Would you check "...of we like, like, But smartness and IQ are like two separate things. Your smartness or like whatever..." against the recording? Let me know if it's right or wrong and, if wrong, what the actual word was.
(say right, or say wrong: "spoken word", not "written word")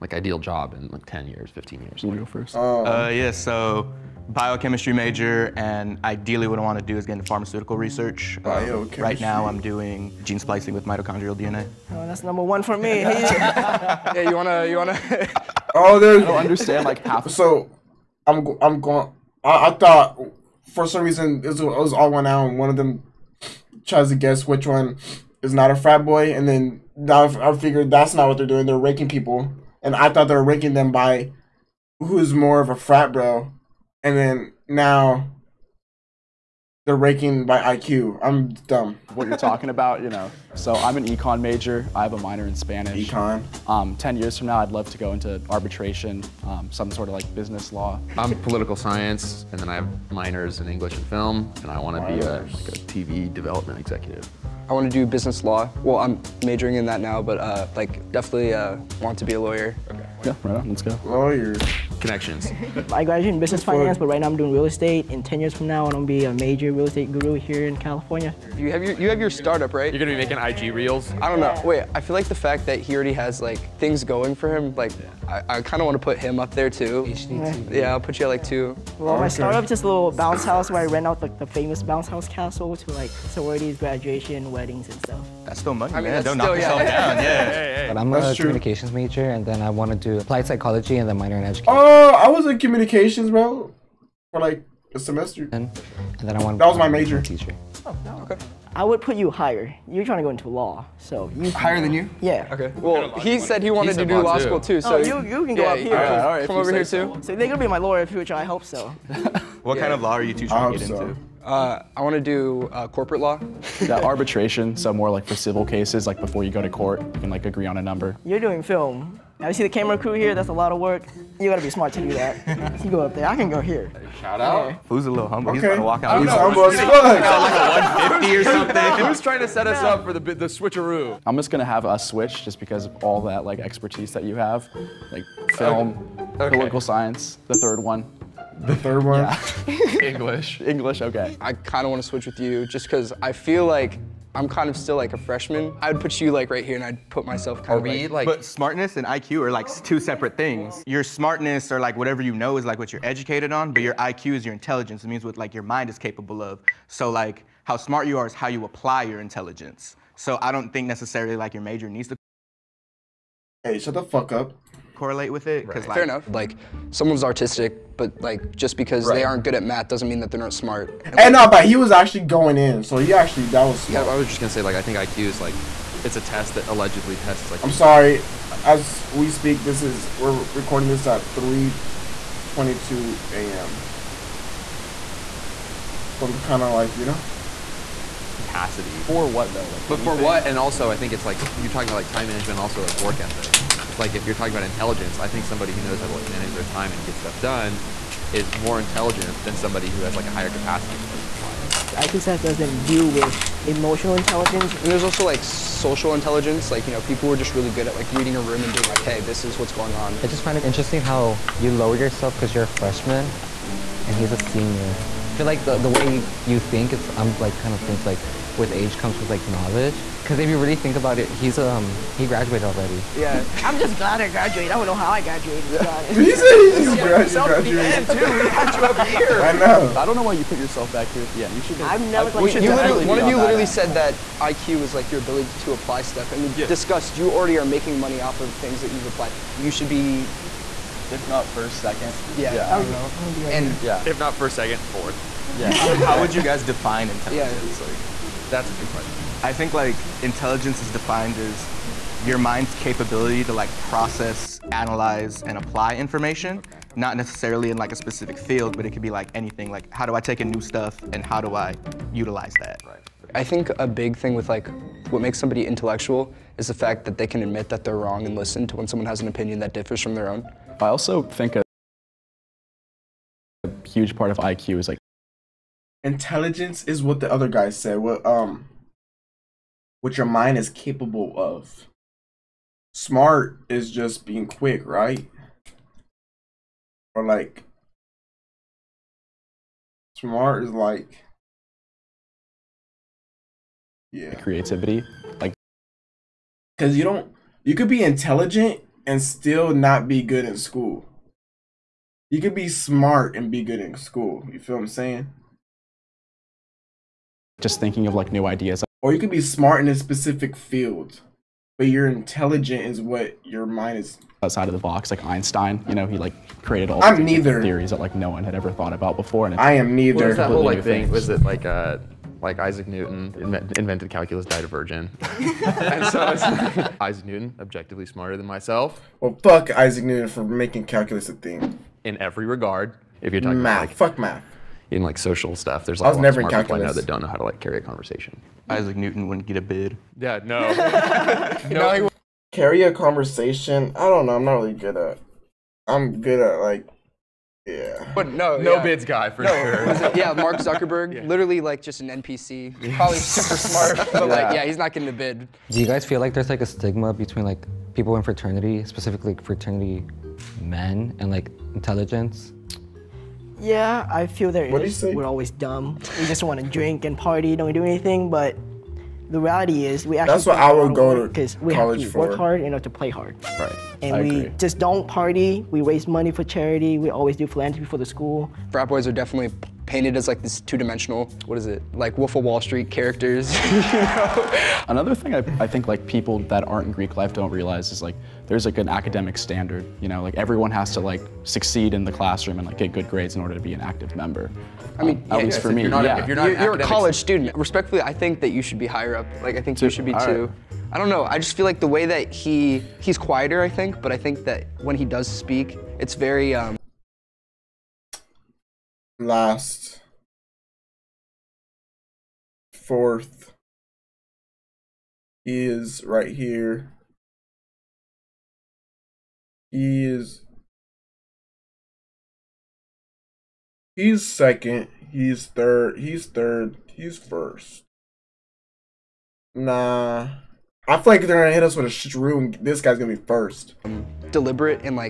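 right.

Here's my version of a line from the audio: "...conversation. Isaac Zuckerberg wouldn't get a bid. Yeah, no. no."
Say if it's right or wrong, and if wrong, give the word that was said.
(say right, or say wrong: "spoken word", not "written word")
wrong: "Newton", not "Zuckerberg".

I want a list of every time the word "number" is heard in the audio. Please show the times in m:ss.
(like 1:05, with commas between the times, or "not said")
0:12, 1:57.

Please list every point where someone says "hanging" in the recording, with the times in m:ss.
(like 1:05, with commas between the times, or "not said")
not said.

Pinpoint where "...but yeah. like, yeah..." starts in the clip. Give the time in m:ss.
5:54.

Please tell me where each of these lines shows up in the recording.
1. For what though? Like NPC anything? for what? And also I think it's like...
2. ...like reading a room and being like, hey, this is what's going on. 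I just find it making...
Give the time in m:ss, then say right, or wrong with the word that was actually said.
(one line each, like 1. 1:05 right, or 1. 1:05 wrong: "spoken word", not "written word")
1. 3:09 wrong: "But", not "NPC"
2. 3:27 wrong: "interesting", not "making".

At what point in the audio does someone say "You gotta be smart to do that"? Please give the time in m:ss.
2:01.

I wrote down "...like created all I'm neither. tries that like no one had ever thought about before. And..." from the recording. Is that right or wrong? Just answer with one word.
wrong.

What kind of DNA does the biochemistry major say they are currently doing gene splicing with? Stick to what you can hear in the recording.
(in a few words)
Mitochondrial DNA.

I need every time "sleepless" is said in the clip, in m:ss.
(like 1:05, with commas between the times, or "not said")
not said.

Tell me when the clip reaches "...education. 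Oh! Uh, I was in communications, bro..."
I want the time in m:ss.
1:31.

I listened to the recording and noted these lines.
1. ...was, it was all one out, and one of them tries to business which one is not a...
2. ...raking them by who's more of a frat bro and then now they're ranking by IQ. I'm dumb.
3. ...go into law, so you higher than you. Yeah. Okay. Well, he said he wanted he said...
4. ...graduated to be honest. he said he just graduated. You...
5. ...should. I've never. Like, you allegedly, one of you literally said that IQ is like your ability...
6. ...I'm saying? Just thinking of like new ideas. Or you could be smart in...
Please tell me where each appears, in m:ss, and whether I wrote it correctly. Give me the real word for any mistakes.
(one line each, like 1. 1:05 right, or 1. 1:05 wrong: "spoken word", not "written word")
1. 0:21 wrong: "guess", not "business"
2. 0:30 right
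3. 1:40 right
4. 3:45 right
5. 3:51 wrong: "literally", not "allegedly"
6. 5:04 right.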